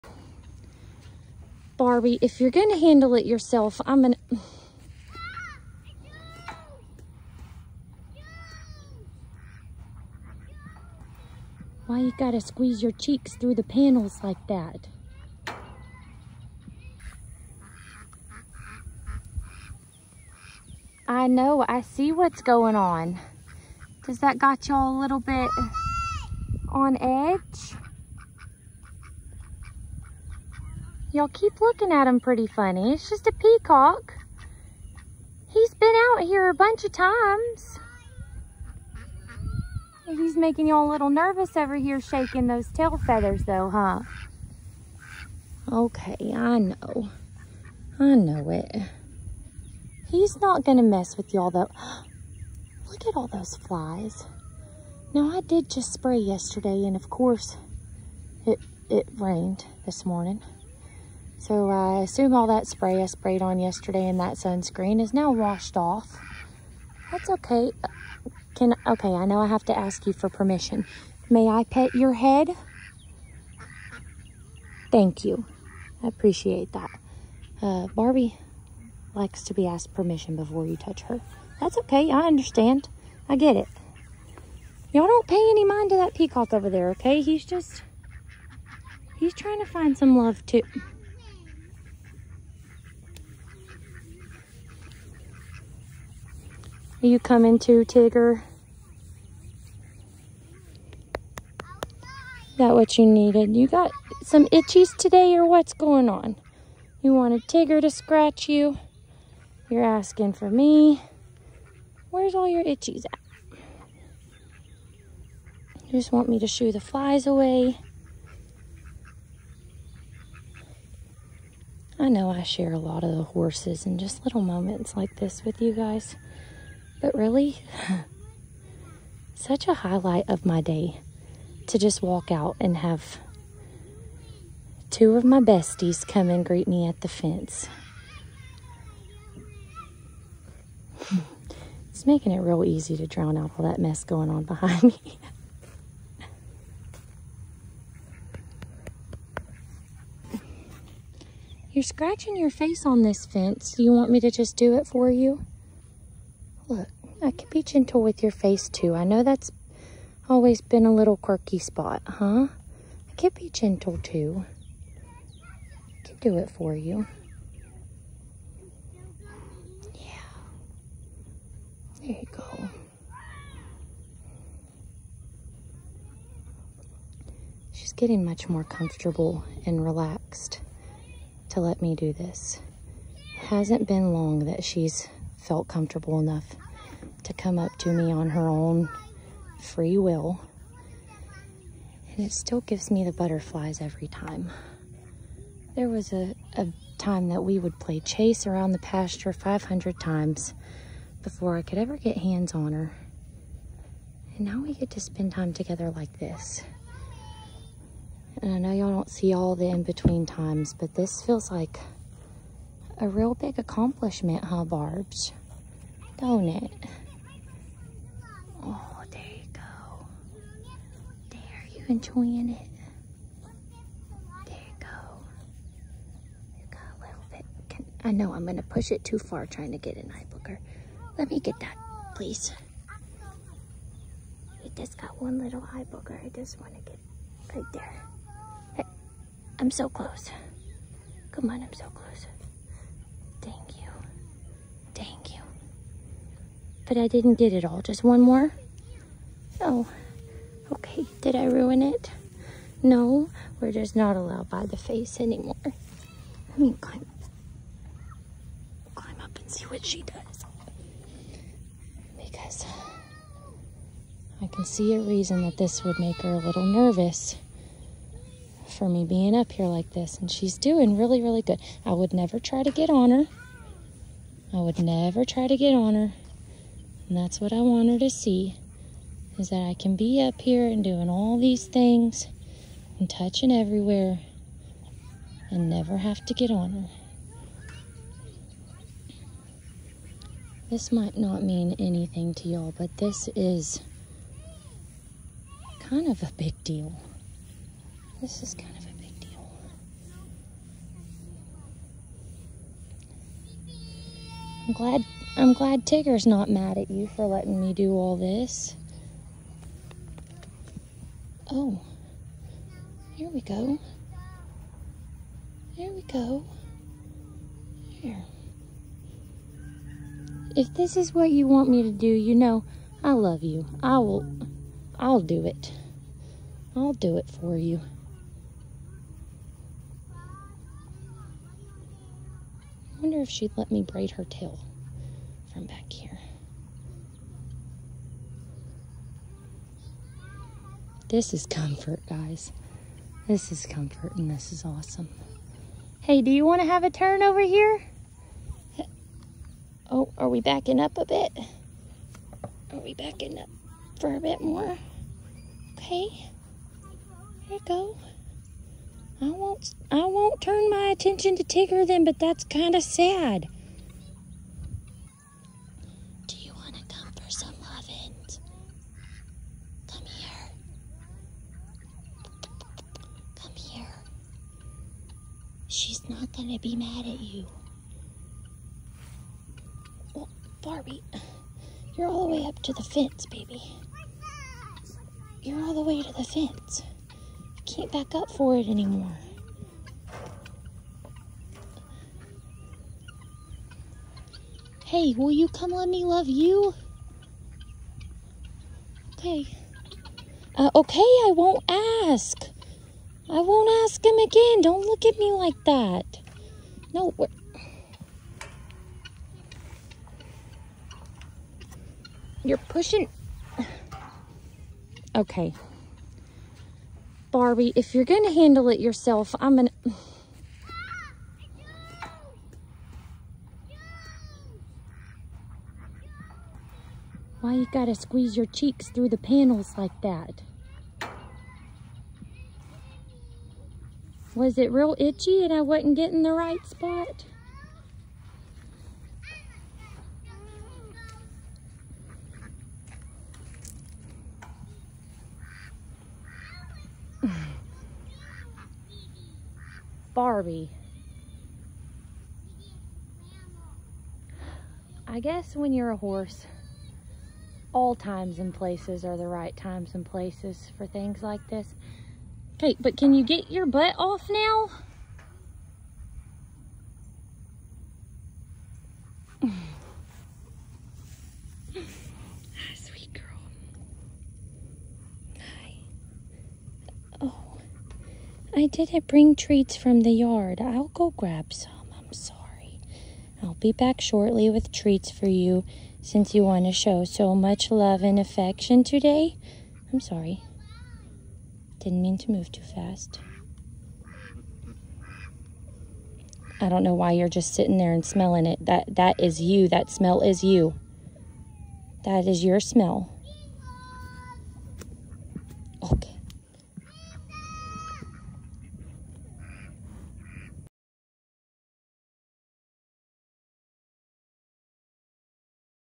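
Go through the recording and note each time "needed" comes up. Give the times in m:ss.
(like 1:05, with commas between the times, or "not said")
1:43.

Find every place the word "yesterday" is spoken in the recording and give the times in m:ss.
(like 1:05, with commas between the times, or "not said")
0:56, 1:03.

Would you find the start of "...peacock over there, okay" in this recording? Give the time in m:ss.
1:26.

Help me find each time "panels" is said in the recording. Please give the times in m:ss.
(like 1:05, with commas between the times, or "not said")
0:13, 7:09.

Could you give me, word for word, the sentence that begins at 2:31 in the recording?
You're scratching your face on this fence.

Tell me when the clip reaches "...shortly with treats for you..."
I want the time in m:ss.
8:03.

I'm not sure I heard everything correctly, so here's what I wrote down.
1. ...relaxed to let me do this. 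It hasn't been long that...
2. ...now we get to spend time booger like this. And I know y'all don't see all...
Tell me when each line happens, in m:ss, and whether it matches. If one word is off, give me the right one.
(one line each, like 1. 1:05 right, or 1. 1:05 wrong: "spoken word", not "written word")
1. 2:59 right
2. 3:24 wrong: "together", not "booger".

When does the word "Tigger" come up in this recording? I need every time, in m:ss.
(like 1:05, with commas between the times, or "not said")
1:37, 1:47, 5:05, 6:01.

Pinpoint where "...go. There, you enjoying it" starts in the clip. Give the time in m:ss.
3:39.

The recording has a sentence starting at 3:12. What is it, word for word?
And it still gives me the butterflies every time.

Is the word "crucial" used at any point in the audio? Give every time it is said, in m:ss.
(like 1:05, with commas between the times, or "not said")
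not said.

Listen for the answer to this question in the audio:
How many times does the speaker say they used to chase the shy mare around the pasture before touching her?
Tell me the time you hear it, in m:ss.
3:19.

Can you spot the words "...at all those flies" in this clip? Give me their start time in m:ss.
0:53.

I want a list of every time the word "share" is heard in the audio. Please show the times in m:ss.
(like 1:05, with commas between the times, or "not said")
2:02.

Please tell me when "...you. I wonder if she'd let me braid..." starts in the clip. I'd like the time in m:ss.
5:27.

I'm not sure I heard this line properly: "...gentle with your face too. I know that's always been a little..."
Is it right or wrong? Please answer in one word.
right.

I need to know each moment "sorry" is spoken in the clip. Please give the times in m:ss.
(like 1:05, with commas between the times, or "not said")
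8:02, 8:09.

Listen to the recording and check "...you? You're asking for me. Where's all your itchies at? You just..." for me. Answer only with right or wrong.
right.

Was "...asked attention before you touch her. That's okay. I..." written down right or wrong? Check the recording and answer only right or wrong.
wrong.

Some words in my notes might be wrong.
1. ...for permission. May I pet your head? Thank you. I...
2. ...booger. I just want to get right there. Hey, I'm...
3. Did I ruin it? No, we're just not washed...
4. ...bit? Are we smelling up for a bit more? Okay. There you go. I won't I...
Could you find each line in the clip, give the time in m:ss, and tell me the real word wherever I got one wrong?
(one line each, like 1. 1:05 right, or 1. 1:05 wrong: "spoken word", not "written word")
1. 1:10 right
2. 3:55 right
3. 4:11 wrong: "allowed", not "washed"
4. 5:51 wrong: "backing", not "smelling".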